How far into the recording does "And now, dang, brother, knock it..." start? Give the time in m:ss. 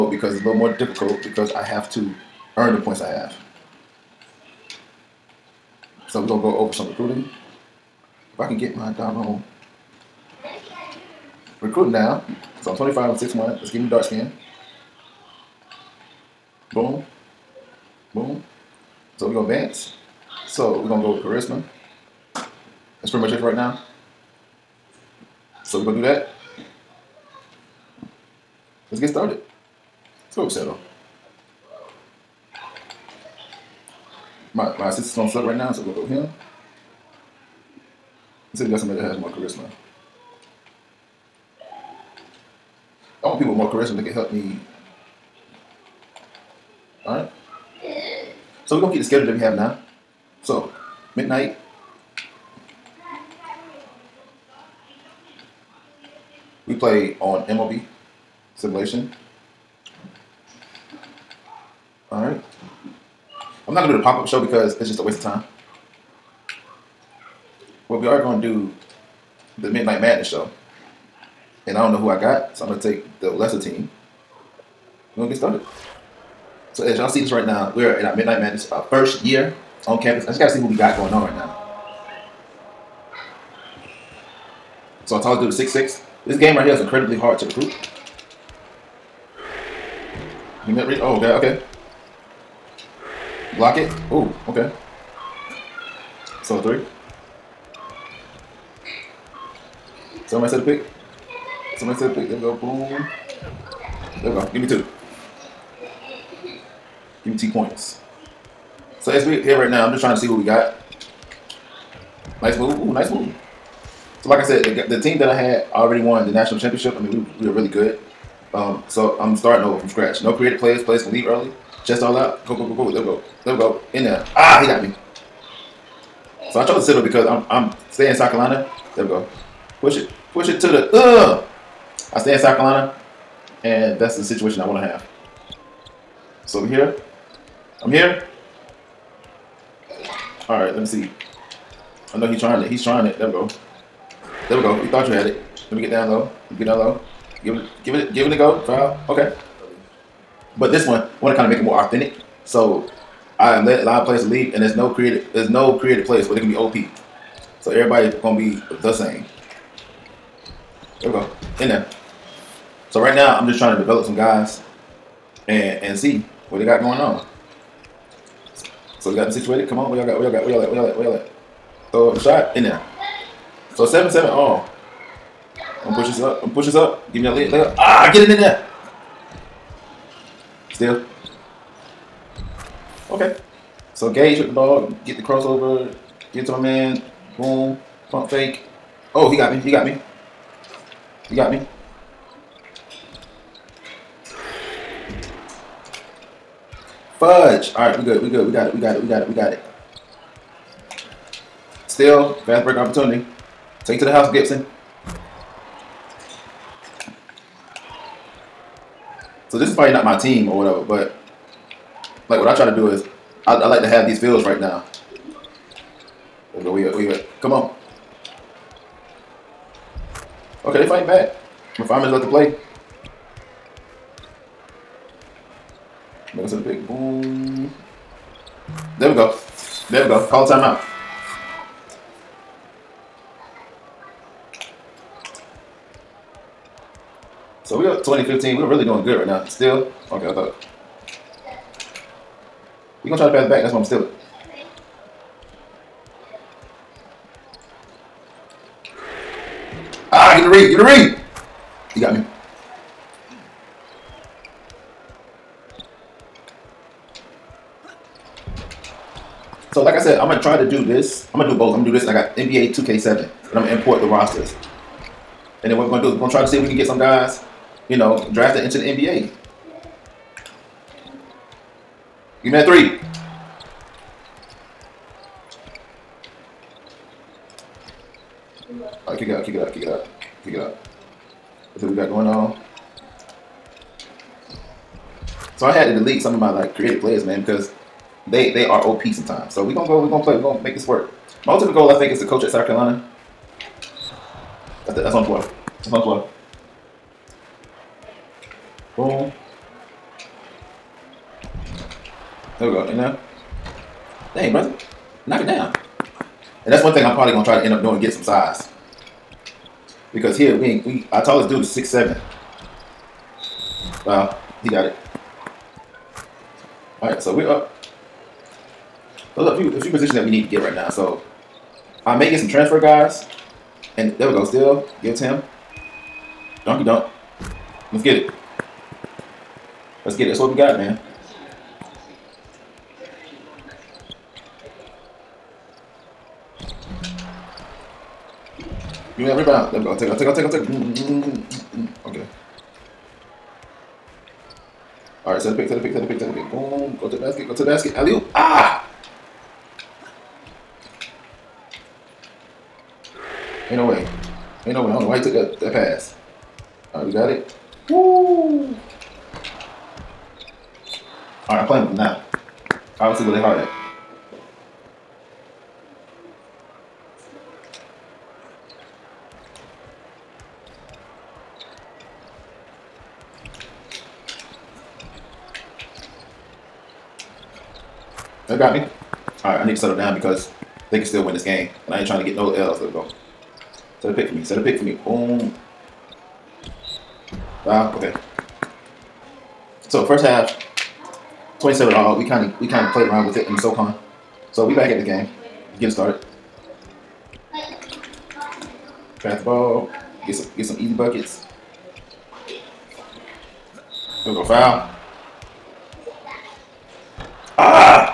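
5:02.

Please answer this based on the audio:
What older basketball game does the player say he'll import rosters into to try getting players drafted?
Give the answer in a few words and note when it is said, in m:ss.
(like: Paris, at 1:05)
NBA 2K7, at 4:22.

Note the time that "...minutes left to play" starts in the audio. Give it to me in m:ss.
3:42.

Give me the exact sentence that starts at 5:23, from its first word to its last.
And there we go, still give to him.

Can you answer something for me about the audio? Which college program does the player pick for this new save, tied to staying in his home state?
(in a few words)
The Citadel.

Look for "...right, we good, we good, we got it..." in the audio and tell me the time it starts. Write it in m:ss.
3:17.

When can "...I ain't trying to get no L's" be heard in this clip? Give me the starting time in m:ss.
6:21.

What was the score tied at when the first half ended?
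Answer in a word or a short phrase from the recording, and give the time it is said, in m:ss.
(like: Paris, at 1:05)
27, at 6:31.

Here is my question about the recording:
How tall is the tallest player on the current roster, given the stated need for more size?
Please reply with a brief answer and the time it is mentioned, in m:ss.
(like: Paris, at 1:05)
6'7, at 5:11.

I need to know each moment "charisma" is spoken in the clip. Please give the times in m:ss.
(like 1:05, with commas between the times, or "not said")
0:21, 0:39, 0:43.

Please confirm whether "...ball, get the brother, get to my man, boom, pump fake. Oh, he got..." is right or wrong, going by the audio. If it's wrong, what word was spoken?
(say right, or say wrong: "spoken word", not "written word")
wrong: "crossover", not "brother".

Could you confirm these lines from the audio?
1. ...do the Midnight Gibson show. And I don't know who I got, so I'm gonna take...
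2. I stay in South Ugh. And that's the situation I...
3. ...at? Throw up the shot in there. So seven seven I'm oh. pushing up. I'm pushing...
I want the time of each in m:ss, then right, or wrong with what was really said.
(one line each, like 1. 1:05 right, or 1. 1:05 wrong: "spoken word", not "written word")
1. 1:08 wrong: "Madness", not "Gibson"
2. 2:12 wrong: "Carolina", not "Ugh"
3. 2:51 right.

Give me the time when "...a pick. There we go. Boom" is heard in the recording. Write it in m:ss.
1:42.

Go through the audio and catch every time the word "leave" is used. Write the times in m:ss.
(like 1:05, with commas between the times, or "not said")
2:01, 2:34.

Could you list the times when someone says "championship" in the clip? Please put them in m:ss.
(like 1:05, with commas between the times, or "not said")
1:56.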